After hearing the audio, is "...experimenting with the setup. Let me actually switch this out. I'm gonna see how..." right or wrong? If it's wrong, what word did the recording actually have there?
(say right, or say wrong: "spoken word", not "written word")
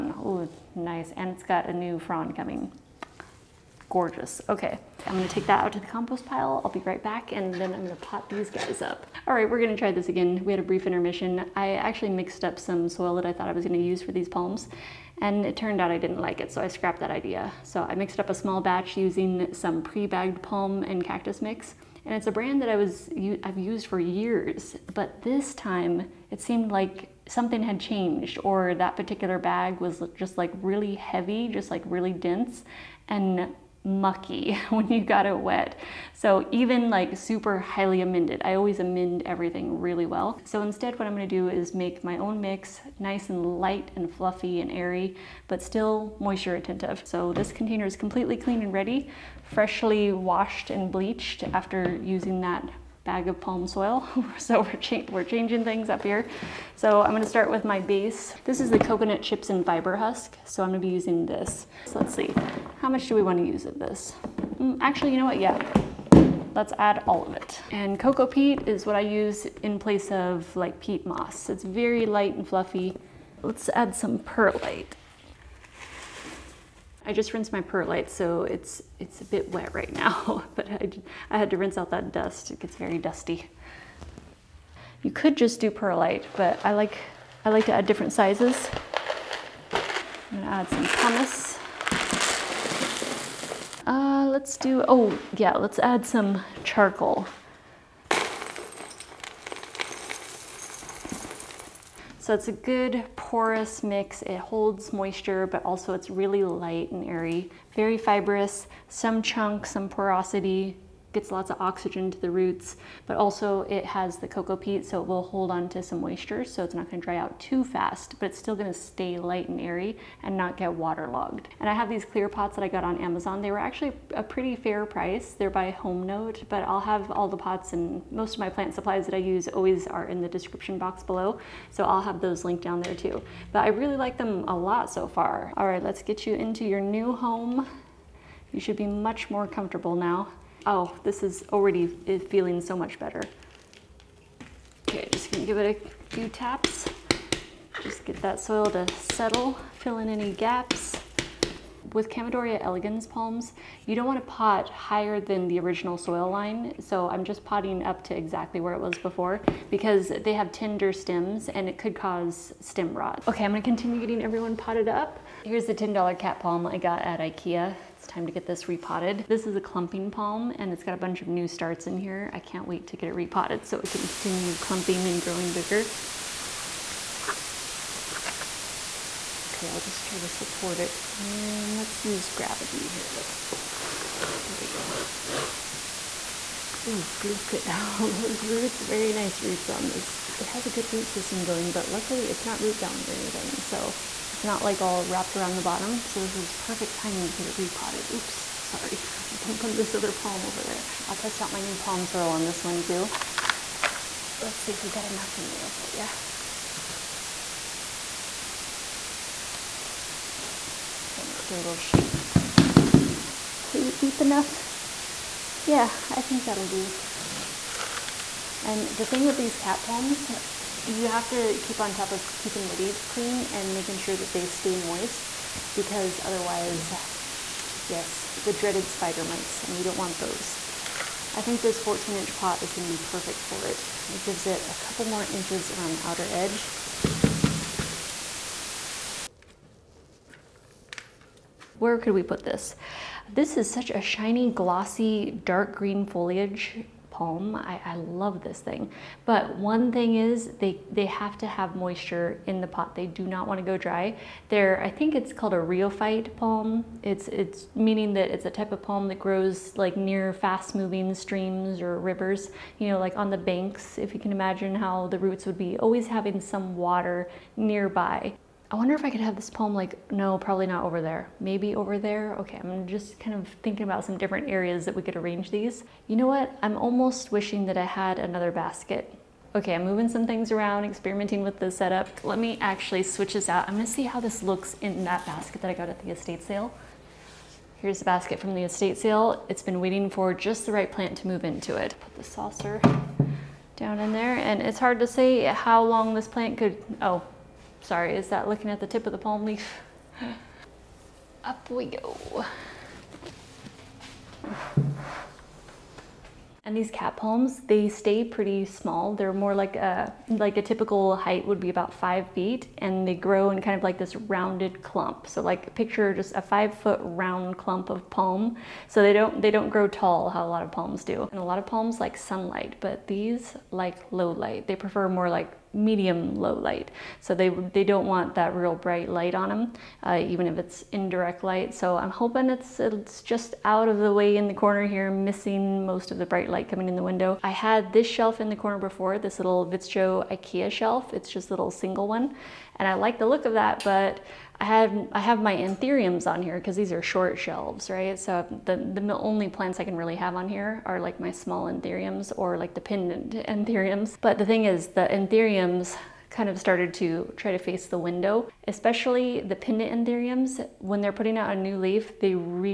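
right.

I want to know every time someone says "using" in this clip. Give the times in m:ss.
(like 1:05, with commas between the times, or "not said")
0:18, 0:52, 1:00.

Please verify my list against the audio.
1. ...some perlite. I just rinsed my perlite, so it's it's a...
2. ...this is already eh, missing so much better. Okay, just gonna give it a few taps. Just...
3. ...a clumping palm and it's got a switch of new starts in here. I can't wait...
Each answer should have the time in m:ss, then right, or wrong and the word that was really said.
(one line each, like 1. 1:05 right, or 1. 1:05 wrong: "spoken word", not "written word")
1. 1:13 right
2. 2:21 wrong: "feeling", not "missing"
3. 2:49 wrong: "bunch", not "switch".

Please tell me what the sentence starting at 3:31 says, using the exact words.
Okay, let's give it a little shake.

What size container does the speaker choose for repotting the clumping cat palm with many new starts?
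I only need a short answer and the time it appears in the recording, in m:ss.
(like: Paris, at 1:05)
14 inch, at 3:51.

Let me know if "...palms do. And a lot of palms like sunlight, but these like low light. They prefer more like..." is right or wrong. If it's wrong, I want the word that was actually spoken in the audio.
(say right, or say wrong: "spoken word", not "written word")
right.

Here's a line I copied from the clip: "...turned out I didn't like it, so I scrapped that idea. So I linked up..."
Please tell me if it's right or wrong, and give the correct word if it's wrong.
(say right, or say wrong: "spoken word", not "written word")
wrong: "mixed", not "linked".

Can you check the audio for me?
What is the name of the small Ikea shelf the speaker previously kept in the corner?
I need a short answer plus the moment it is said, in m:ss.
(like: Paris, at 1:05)
Vittsjo, at 5:39.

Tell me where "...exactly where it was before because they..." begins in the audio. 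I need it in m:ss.
2:38.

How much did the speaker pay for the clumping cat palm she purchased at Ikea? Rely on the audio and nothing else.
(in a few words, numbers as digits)
$10.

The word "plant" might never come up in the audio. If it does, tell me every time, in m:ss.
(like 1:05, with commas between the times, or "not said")
2:08, 4:50, 4:56, 5:49.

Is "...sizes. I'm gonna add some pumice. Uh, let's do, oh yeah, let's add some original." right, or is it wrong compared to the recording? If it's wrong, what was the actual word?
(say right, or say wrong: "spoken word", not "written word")
wrong: "charcoal", not "original".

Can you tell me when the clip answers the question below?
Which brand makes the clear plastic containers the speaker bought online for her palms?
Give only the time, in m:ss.
2:05.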